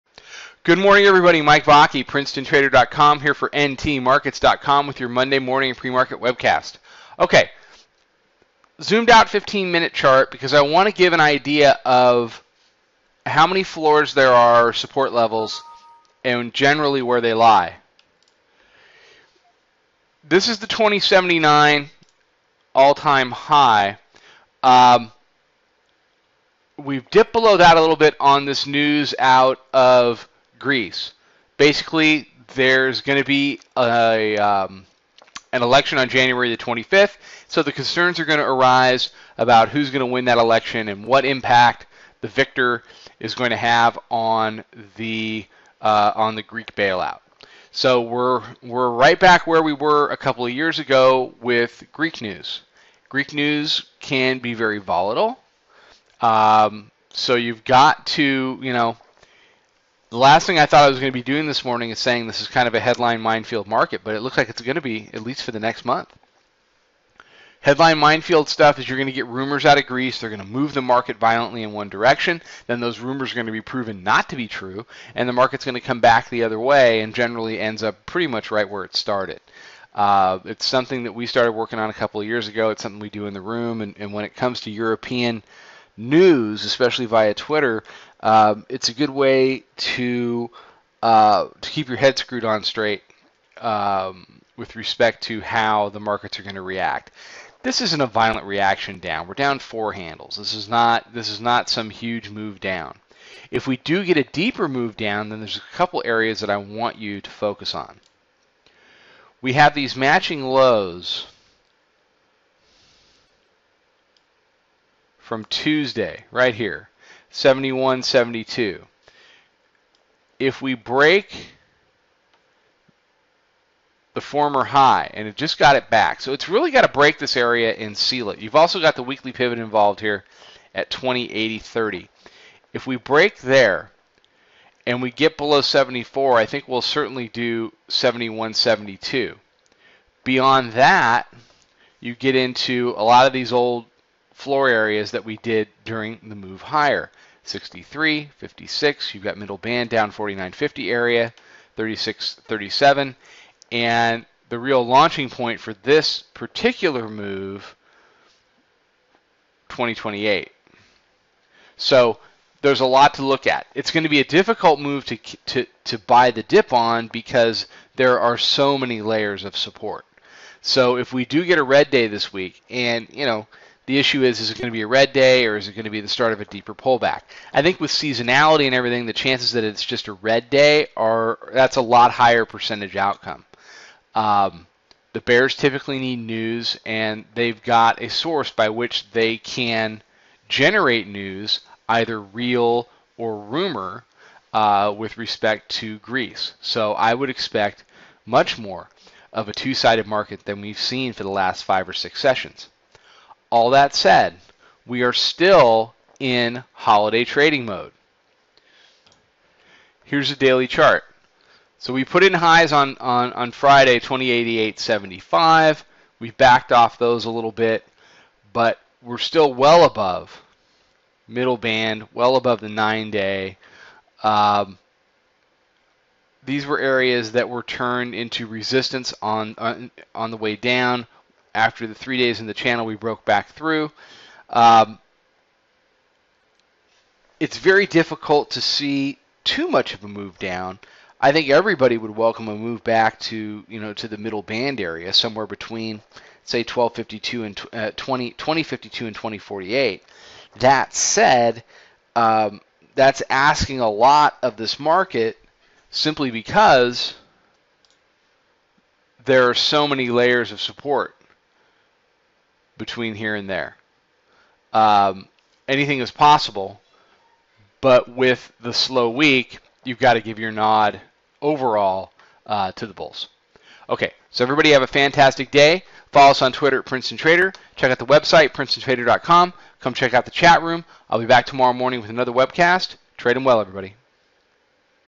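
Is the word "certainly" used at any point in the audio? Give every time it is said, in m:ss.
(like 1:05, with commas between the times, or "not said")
2:16.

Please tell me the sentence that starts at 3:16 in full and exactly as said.
So I would expect much more of a two sided market than we've seen for the last five or six sessions.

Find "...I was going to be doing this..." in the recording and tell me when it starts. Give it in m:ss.
1:00.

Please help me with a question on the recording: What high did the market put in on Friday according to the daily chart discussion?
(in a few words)
2088.75.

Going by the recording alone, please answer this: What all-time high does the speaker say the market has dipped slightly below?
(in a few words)
2079.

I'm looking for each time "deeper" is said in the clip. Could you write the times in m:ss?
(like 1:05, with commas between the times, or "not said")
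1:44, 2:56.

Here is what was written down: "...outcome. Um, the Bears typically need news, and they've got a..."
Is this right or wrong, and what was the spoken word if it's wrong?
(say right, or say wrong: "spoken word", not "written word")
right.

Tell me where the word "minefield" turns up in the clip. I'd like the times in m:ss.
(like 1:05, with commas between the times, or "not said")
1:03, 1:07.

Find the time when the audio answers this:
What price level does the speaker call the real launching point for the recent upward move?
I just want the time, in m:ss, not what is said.
2:39.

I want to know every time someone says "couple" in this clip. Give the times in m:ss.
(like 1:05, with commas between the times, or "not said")
0:50, 1:21, 1:45.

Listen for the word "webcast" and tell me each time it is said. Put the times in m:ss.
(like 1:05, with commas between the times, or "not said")
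0:06, 4:42.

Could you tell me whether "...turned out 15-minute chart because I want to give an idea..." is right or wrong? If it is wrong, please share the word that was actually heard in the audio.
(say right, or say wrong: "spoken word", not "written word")
wrong: "zoomed", not "turned".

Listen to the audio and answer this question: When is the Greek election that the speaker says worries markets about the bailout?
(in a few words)
January 25th.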